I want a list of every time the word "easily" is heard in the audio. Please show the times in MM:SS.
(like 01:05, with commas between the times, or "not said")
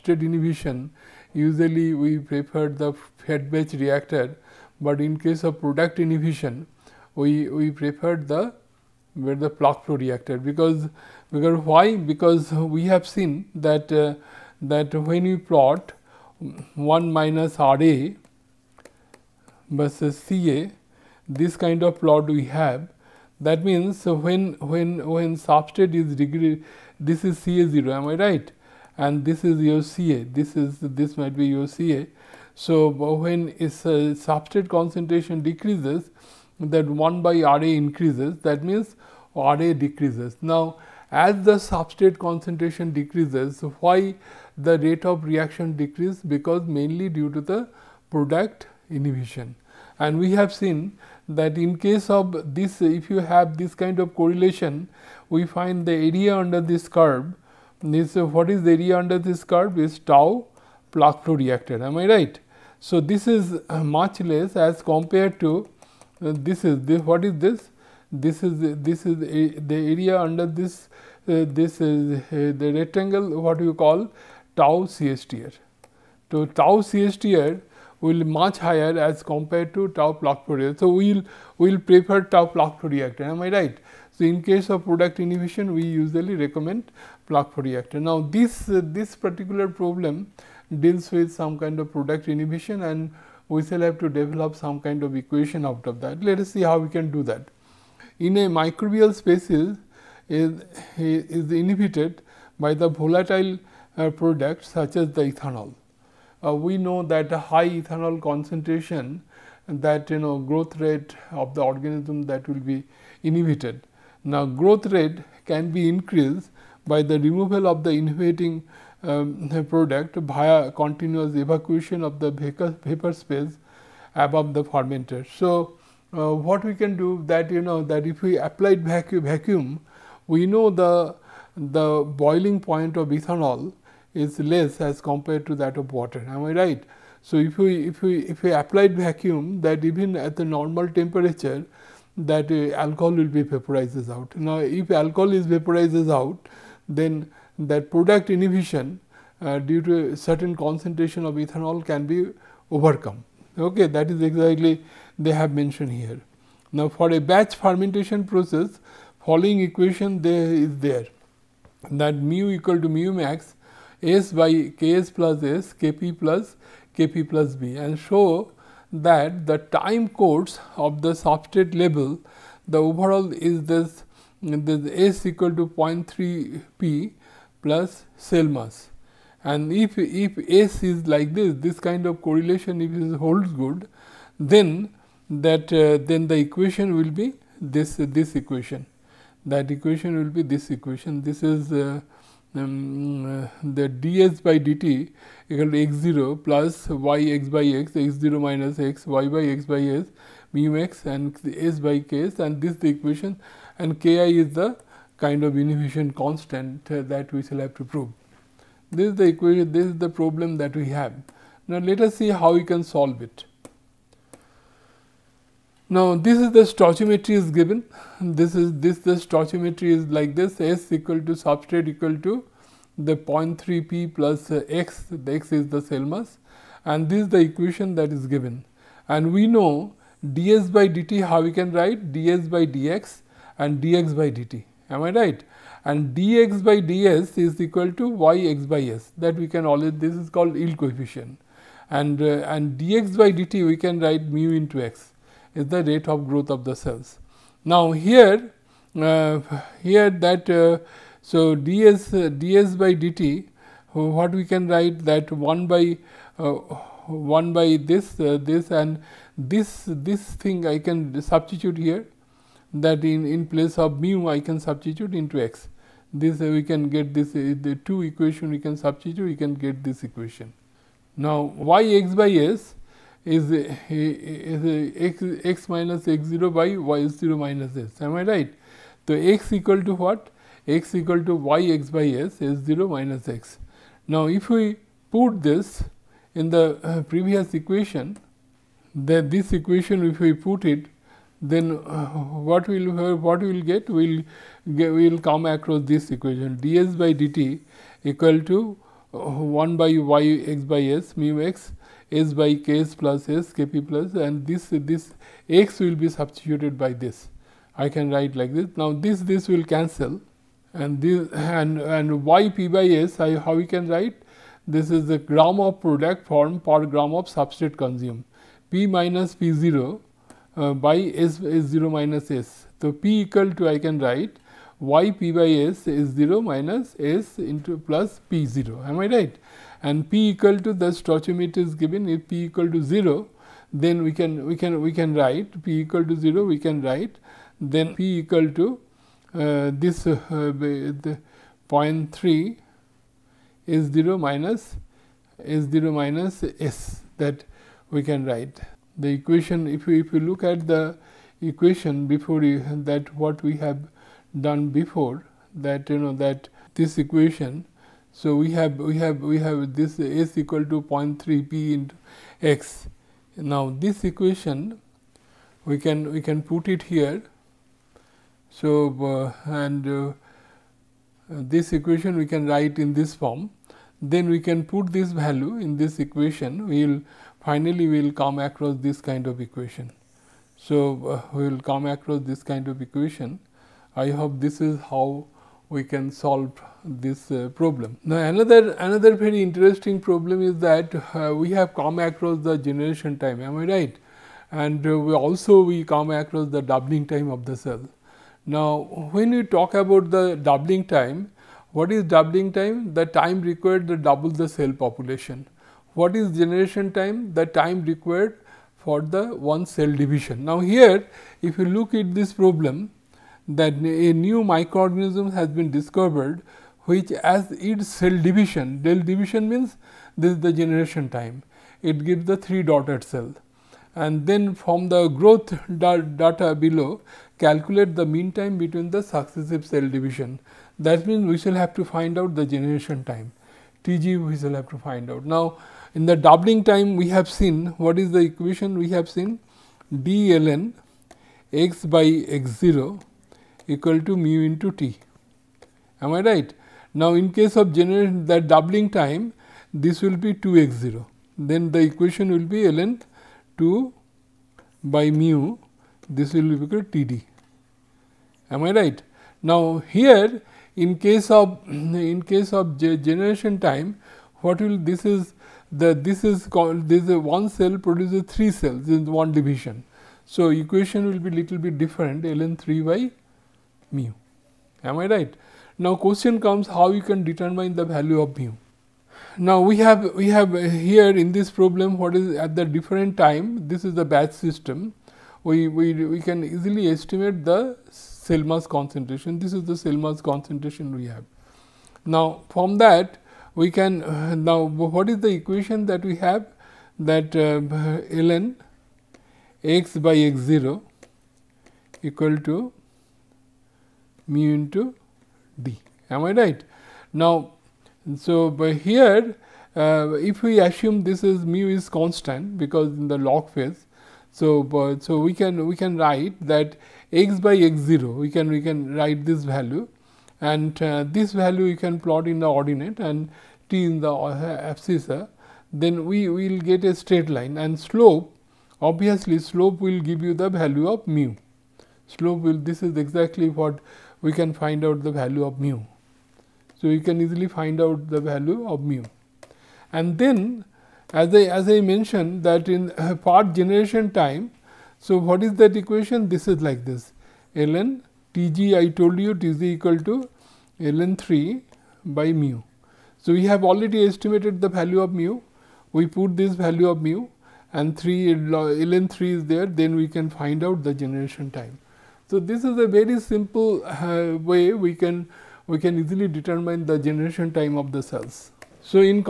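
08:06, 08:57, 09:26.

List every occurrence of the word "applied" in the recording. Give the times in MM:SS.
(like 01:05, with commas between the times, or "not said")
02:08, 02:18.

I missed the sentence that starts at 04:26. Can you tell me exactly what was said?
This uh, we can get this uh, the two equation we can substitute we can get this equation.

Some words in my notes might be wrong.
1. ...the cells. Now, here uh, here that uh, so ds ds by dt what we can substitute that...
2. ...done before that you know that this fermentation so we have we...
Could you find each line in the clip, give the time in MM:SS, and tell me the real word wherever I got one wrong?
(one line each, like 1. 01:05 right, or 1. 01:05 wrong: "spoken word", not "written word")
1. 04:06 wrong: "write", not "substitute"
2. 05:54 wrong: "equation", not "fermentation".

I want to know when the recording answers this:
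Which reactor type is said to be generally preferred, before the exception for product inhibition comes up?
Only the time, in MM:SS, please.
00:03.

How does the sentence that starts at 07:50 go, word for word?
So, equation will be little bit different ln 3 by mu am I right.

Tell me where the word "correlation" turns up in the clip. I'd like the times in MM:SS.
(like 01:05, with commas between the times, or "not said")
00:54, 03:02.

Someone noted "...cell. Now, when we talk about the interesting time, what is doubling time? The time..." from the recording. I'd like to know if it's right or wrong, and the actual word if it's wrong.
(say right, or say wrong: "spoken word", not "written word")
wrong: "doubling", not "interesting".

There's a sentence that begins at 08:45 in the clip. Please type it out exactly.
Uh, then we will get a straight line and slope obviously slope will give you the value of mu.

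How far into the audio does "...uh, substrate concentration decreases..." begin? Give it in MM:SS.
00:33.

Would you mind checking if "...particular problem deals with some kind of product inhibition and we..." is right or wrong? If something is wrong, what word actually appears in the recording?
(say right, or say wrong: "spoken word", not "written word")
right.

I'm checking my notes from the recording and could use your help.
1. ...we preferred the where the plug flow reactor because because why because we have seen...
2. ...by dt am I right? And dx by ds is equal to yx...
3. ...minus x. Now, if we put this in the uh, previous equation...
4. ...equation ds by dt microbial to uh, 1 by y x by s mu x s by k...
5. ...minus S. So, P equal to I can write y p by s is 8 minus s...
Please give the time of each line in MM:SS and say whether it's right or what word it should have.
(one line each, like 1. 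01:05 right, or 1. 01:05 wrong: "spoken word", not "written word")
1. 00:07 right
2. 03:54 right
3. 04:42 right
4. 04:56 wrong: "equal", not "microbial"
5. 05:21 wrong: "0", not "8".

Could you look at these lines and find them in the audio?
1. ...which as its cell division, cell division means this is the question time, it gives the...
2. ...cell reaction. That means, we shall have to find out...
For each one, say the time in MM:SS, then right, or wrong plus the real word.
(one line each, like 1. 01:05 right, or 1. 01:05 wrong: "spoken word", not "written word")
1. 06:56 wrong: "generation", not "question"
2. 07:09 wrong: "division", not "reaction".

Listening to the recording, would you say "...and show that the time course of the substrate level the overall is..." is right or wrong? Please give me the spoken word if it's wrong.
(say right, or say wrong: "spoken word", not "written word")
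right.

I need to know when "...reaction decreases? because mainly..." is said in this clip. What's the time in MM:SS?
00:45.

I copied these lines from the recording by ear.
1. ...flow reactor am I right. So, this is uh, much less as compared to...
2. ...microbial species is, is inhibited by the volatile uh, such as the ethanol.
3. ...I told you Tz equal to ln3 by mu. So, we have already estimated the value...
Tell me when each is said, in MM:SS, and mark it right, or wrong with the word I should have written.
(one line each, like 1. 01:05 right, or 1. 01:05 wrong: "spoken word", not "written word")
1. 01:01 right
2. 01:38 right
3. 09:08 right.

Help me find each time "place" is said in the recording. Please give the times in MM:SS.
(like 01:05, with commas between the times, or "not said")
04:23.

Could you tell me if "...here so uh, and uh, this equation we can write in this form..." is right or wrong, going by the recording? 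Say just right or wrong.
right.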